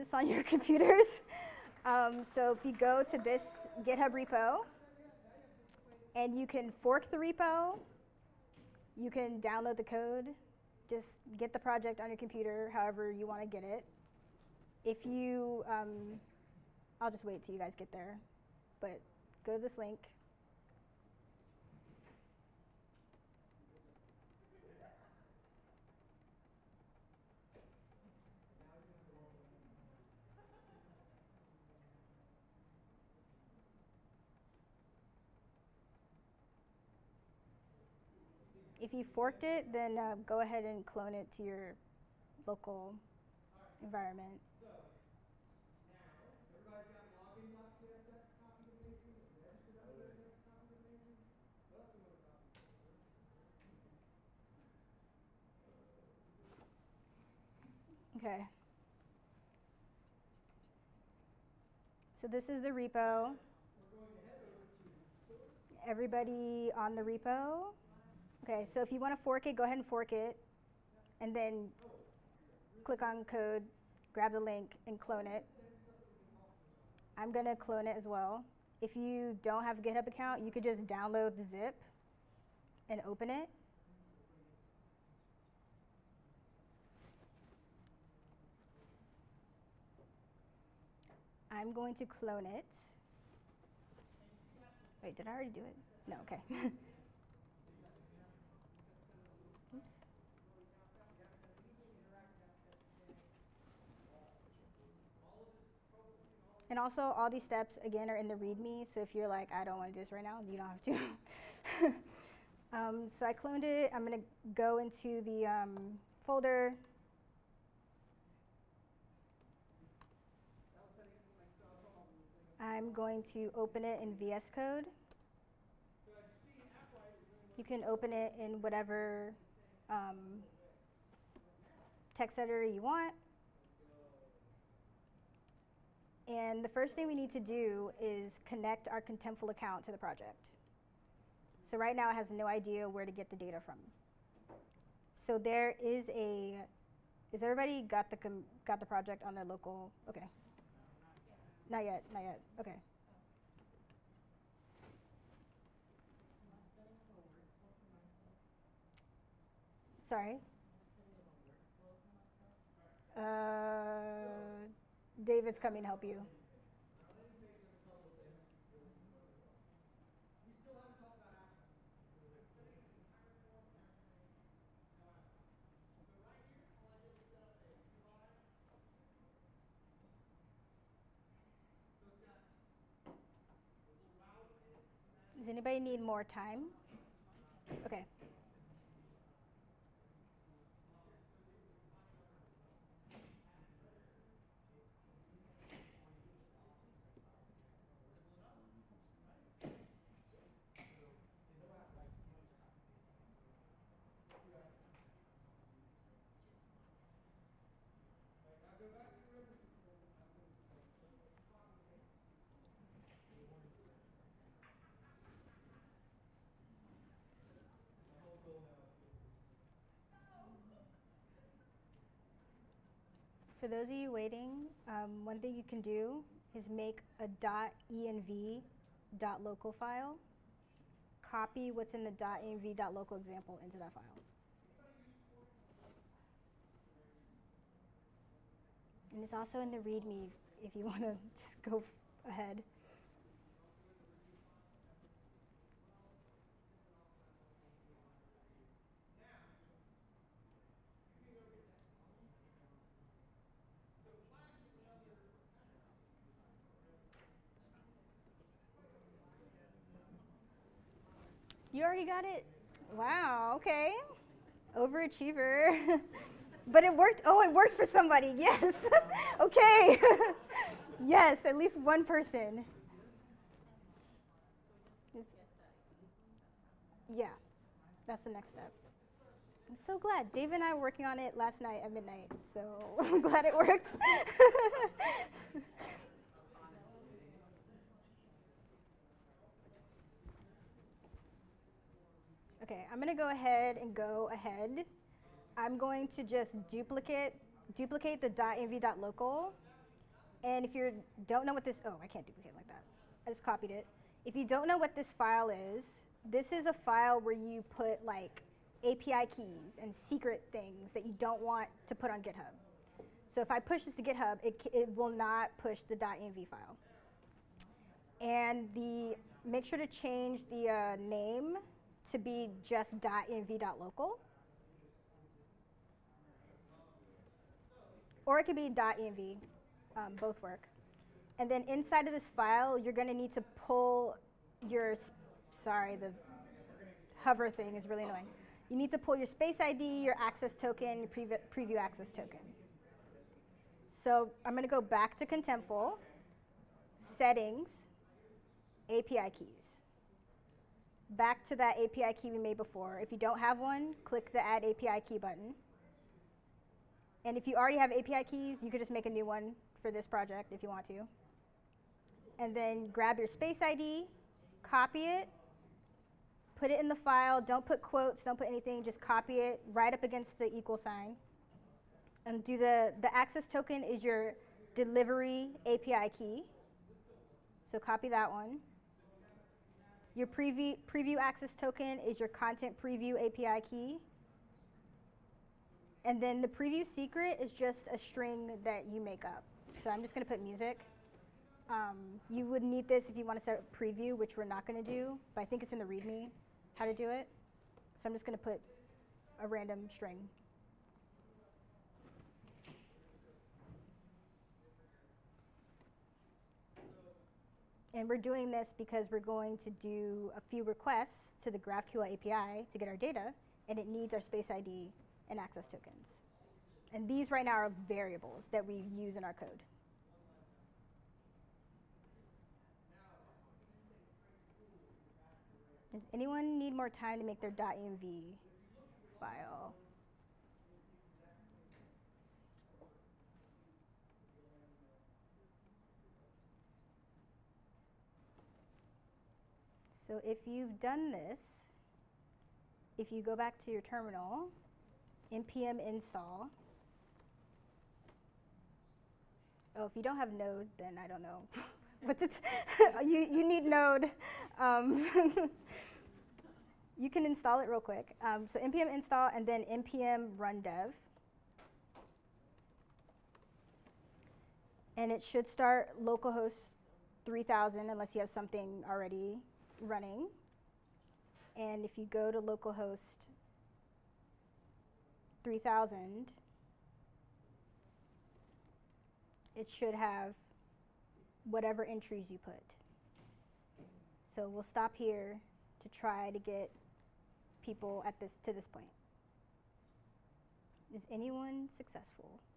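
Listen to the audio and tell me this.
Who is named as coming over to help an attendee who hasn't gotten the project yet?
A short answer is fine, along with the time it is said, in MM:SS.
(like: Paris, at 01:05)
David, at 02:45.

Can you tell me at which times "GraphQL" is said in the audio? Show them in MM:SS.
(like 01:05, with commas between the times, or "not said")
06:51.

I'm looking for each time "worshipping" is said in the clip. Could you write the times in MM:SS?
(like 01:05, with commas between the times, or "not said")
not said.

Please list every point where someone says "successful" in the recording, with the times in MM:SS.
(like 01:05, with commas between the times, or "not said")
08:11.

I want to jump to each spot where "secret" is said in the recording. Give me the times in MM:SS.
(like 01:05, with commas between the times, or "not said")
05:10, 06:26.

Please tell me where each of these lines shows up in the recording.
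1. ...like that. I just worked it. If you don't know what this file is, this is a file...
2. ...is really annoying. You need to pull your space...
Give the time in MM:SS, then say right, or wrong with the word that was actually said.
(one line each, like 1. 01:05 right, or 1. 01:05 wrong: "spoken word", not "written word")
1. 05:02 wrong: "copied", not "worked"
2. 05:37 right.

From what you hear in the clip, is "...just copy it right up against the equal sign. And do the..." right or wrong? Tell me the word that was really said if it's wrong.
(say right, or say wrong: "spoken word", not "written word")
right.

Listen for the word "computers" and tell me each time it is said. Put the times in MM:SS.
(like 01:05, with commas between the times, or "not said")
00:00, 00:12.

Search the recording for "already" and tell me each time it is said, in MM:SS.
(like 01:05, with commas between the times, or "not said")
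01:35, 04:21, 05:57, 07:48.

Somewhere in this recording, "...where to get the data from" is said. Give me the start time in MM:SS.
02:22.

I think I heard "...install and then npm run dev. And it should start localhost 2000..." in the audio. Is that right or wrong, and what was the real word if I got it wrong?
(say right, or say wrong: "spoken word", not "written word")
wrong: "3000", not "2000".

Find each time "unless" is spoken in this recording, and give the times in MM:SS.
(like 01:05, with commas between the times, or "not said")
07:47.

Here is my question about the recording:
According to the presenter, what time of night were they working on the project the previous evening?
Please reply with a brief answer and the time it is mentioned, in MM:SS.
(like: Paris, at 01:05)
midnight, at 04:41.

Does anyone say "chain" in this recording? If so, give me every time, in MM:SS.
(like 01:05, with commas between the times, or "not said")
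not said.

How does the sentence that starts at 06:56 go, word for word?
And these right now are variables that we use in our code.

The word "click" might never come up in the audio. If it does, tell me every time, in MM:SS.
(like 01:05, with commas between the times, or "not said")
01:12, 05:54.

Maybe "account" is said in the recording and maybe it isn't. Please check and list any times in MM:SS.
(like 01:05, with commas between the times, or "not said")
01:20, 02:19.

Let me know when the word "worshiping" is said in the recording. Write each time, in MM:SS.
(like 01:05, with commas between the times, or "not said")
not said.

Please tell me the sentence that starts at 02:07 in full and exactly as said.
You can open it in whatever um, text editor you want.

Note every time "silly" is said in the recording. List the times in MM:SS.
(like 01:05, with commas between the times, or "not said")
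not said.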